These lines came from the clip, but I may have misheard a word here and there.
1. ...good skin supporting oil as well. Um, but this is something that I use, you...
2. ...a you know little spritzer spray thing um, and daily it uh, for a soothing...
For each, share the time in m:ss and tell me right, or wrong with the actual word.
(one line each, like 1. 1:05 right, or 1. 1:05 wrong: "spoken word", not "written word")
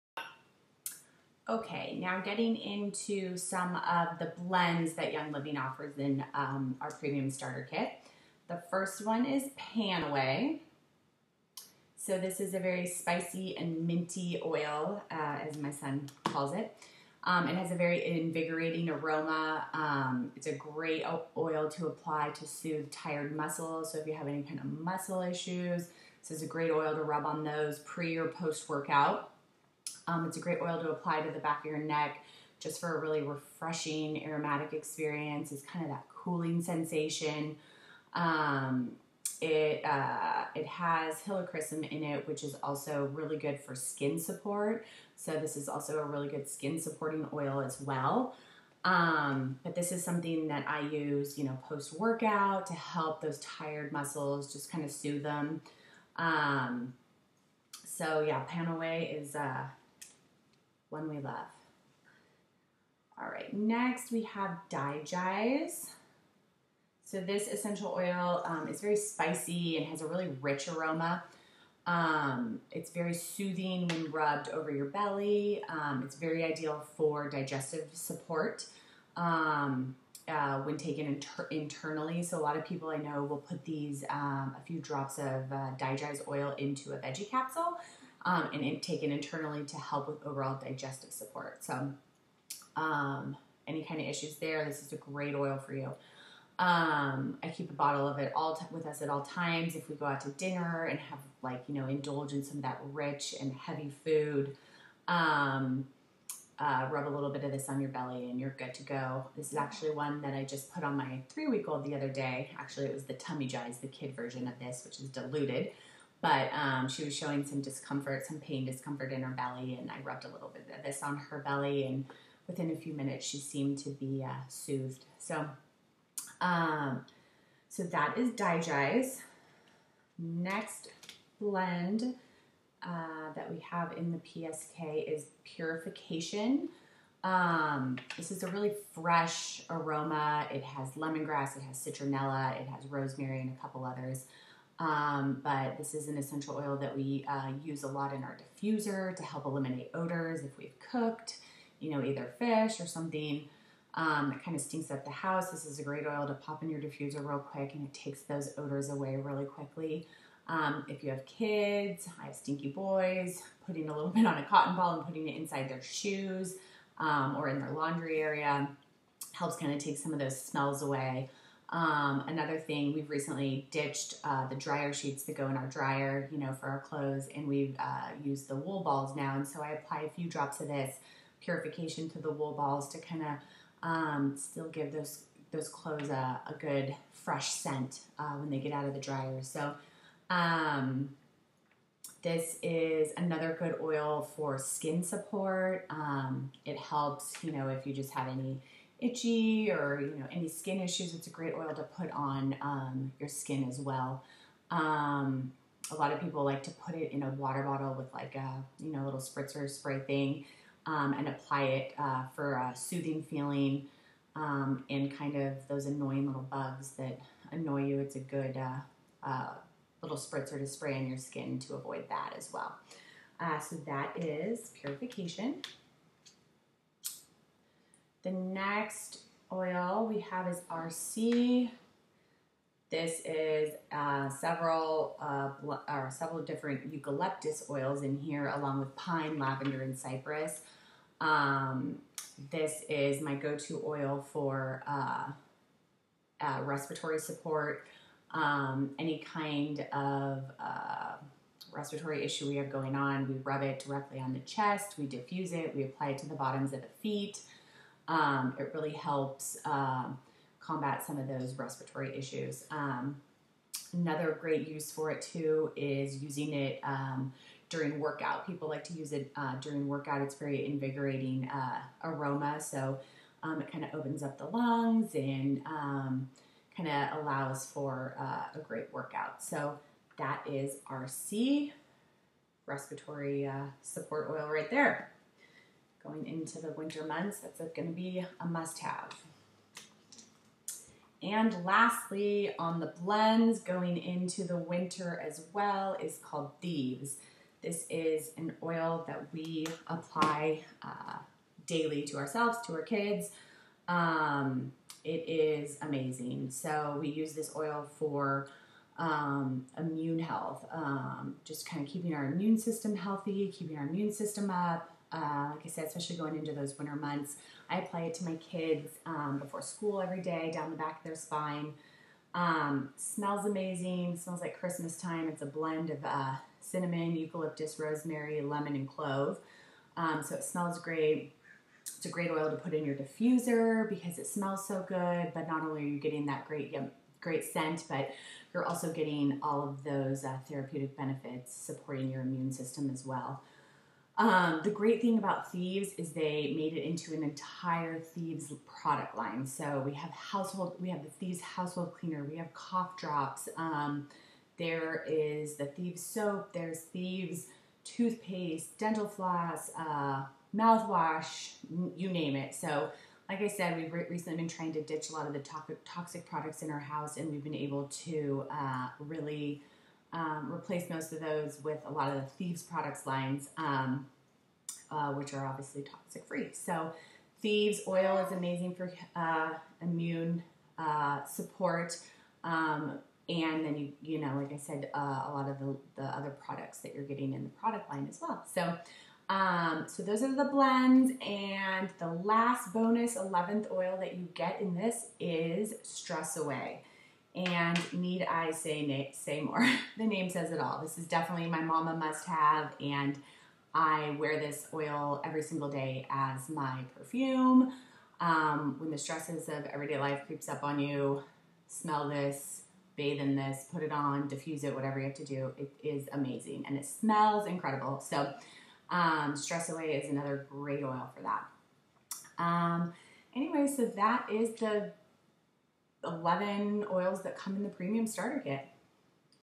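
1. 0:46 right
2. 3:28 wrong: "apply", not "daily".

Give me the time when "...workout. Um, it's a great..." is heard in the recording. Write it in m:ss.
0:28.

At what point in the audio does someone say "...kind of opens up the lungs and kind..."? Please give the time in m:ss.
4:33.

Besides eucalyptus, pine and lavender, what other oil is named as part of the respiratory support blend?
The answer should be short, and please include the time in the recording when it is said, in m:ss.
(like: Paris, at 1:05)
Cypress, at 3:59.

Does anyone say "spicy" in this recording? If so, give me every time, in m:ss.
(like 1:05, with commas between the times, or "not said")
0:12, 1:08.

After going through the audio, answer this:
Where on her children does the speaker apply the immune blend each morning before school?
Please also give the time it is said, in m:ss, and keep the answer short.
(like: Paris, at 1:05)
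Down the back of their spine, at 5:20.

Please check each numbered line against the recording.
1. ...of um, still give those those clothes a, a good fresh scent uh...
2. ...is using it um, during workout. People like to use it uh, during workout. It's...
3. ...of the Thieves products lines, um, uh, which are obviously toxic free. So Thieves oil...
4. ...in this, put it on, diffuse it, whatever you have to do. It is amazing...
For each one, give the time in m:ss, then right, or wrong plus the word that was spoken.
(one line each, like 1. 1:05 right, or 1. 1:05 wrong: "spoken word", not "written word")
1. 3:03 right
2. 4:25 right
3. 6:12 right
4. 6:53 right.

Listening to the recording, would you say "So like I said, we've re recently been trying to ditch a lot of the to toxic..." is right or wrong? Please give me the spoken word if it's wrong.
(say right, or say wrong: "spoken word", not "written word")
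right.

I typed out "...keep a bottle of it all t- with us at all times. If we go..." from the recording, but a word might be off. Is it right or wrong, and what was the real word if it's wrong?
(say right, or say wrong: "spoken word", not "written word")
right.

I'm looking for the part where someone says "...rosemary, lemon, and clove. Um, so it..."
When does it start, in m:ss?
5:27.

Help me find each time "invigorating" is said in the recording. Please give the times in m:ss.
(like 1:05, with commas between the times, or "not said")
0:18, 4:30.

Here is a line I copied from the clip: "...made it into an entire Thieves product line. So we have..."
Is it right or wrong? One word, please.
right.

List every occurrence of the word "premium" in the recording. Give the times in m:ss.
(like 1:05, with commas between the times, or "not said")
0:06, 7:07.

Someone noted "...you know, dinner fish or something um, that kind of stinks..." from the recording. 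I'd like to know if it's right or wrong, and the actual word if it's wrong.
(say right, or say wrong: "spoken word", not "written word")
wrong: "either", not "dinner".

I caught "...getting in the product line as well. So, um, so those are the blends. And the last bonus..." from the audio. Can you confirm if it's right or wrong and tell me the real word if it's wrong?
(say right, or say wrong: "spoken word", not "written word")
right.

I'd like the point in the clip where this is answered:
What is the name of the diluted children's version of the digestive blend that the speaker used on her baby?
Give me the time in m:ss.
1:53.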